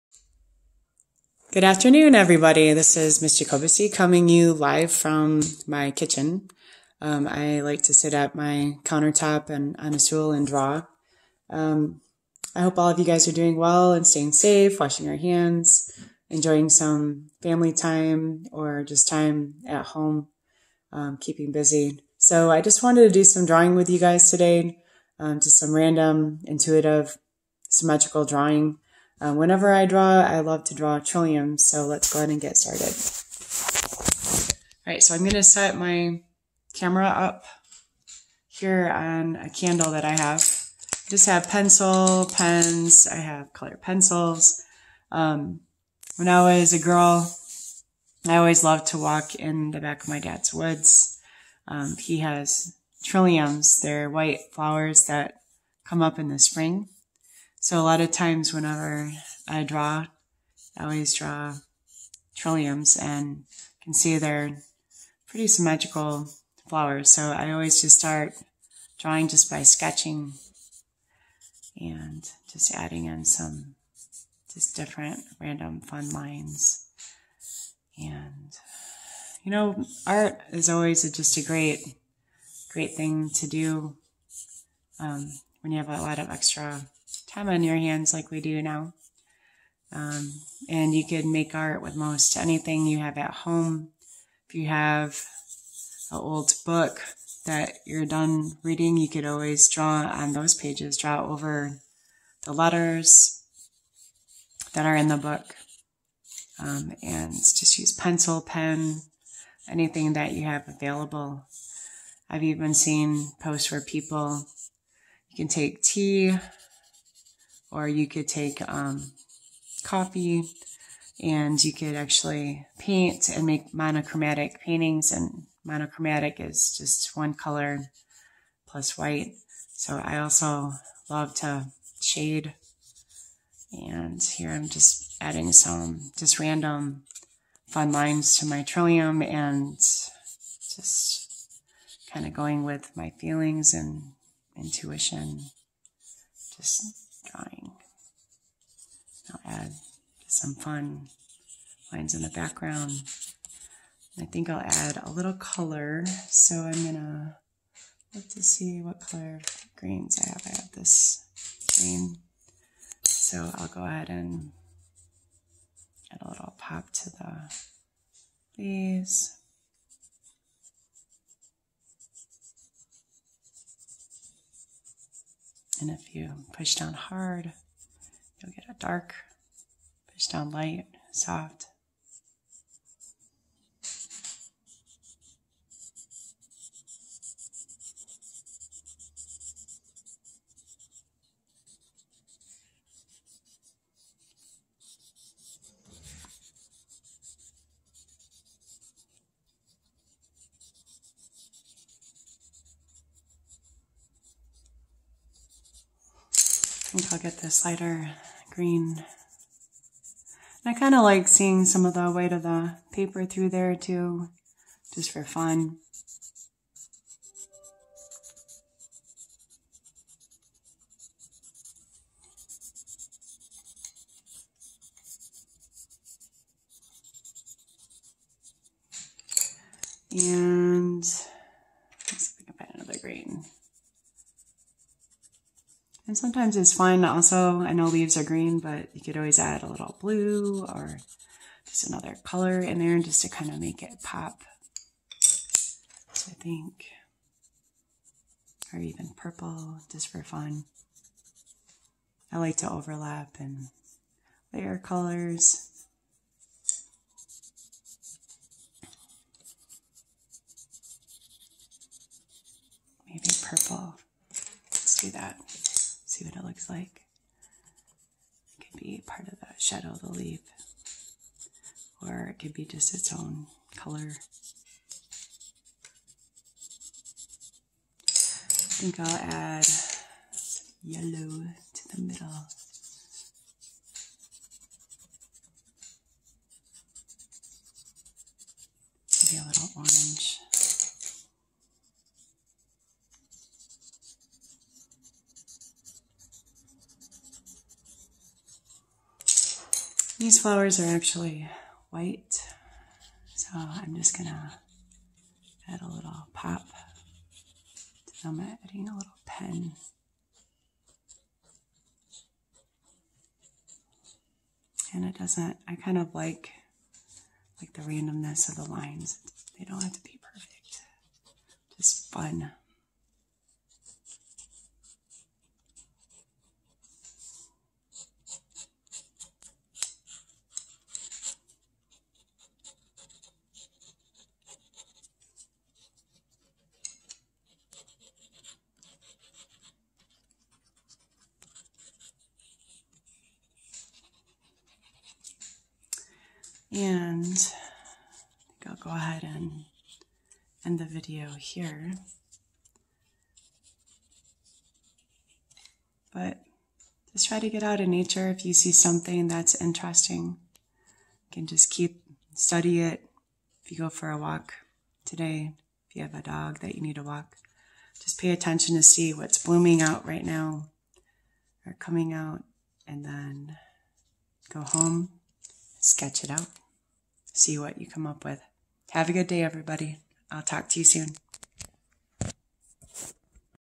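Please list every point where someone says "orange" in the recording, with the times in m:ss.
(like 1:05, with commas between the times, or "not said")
4:49.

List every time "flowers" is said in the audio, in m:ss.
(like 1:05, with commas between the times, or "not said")
0:54, 1:06, 5:00.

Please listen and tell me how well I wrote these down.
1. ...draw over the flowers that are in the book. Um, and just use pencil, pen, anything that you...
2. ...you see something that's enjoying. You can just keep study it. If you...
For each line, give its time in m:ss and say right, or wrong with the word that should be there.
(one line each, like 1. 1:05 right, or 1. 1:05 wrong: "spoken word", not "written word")
1. 1:40 wrong: "letters", not "flowers"
2. 5:58 wrong: "interesting", not "enjoying".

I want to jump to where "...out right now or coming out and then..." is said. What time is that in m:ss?
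6:09.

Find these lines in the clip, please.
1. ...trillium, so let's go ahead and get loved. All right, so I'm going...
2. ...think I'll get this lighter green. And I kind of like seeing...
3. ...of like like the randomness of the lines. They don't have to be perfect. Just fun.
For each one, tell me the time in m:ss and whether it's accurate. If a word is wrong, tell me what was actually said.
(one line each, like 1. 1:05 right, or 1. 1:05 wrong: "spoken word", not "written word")
1. 0:30 wrong: "started", not "loved"
2. 3:26 right
3. 5:15 right.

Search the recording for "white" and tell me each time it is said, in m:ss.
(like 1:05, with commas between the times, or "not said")
0:54, 2:08, 5:01.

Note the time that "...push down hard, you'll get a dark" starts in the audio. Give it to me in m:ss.
2:56.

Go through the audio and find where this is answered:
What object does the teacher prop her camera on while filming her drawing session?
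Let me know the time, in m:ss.
0:39.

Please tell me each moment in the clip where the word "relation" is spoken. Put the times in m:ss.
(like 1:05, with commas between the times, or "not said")
not said.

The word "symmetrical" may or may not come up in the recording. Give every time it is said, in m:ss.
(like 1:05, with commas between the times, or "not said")
0:27, 1:05.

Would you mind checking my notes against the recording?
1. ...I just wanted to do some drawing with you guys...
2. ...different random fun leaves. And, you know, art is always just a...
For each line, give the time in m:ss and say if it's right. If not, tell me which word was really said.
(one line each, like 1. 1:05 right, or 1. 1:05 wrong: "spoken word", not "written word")
1. 0:22 right
2. 1:14 wrong: "lines", not "leaves".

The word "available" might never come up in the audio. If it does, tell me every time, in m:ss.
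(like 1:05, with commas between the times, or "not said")
1:50.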